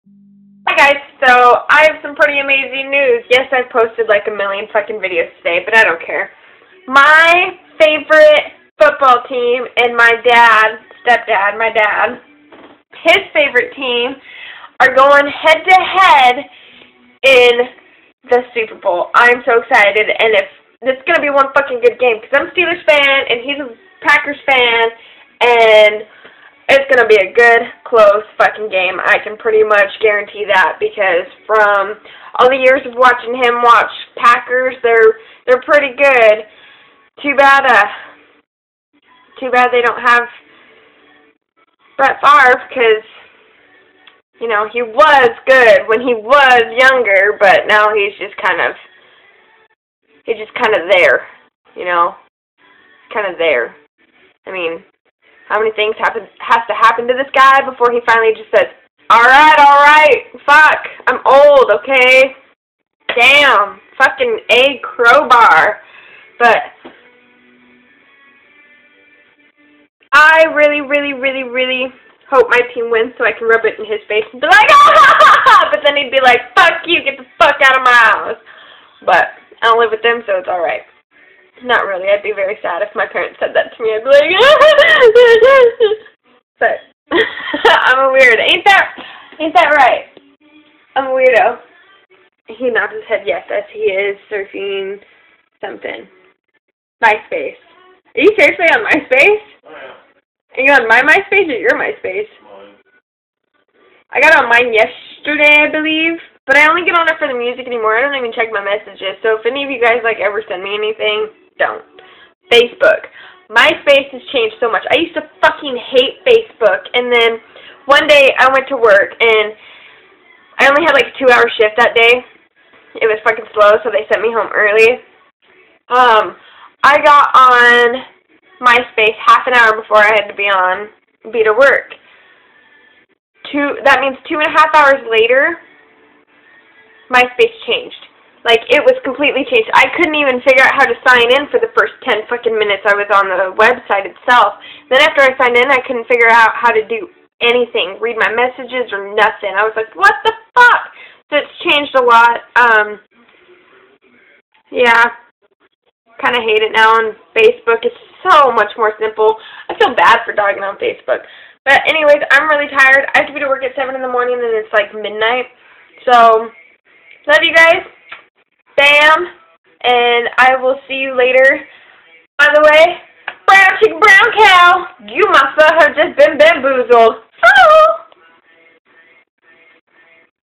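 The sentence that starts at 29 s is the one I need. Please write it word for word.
I can pretty much guarantee that because from all the years of watching him watch Packers, they're they're pretty good.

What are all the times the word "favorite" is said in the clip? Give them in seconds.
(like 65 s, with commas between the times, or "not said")
7 s, 13 s.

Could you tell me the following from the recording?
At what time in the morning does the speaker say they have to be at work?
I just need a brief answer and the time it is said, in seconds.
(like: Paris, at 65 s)
7, at 163 s.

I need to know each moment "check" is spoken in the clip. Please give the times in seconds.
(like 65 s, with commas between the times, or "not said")
108 s.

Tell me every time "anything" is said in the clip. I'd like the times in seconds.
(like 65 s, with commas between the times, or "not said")
110 s, 147 s.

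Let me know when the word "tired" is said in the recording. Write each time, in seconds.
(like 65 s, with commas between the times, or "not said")
162 s.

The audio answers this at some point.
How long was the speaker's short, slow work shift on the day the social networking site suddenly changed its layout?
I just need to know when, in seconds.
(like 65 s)
121 s.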